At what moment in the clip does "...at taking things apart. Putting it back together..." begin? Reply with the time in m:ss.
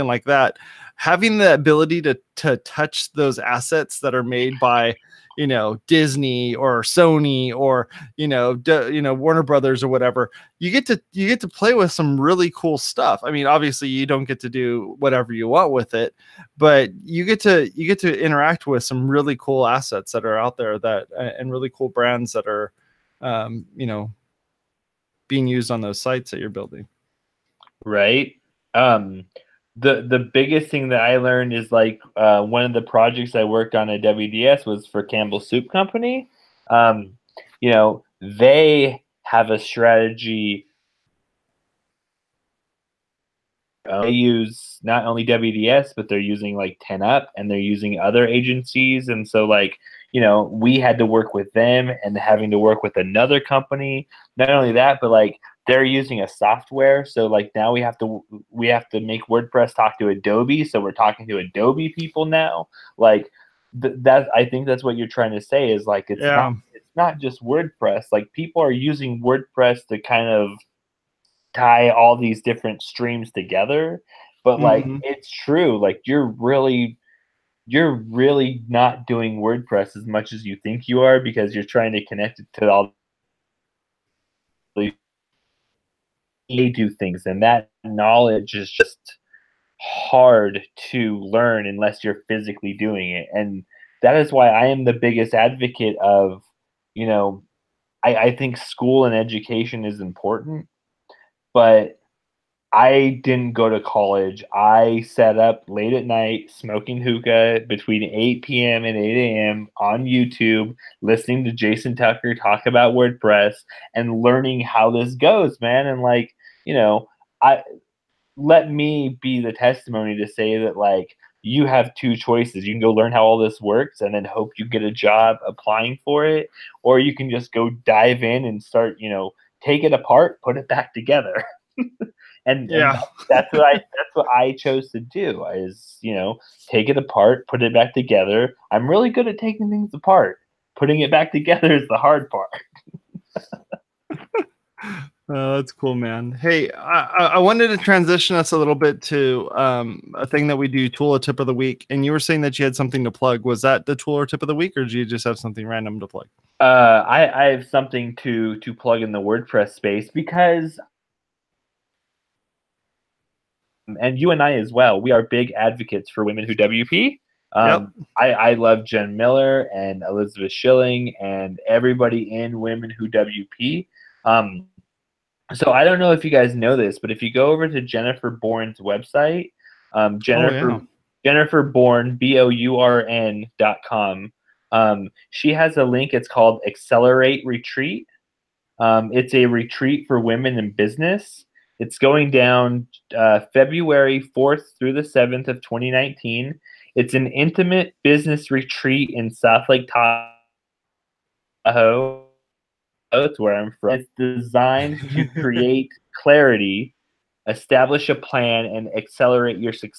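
2:19.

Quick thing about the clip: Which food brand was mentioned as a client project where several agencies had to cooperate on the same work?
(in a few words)
Campbell Soup Company.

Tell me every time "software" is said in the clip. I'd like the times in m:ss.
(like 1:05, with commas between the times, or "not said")
0:56.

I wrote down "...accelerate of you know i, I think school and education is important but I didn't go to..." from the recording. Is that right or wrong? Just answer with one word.
wrong.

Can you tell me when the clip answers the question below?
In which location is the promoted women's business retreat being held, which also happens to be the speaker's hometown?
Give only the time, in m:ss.
3:19.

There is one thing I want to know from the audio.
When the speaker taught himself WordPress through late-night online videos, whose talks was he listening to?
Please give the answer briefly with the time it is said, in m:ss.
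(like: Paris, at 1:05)
Jason Tucker, at 1:51.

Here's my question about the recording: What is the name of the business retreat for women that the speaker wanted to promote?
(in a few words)
Accelerate Retreat.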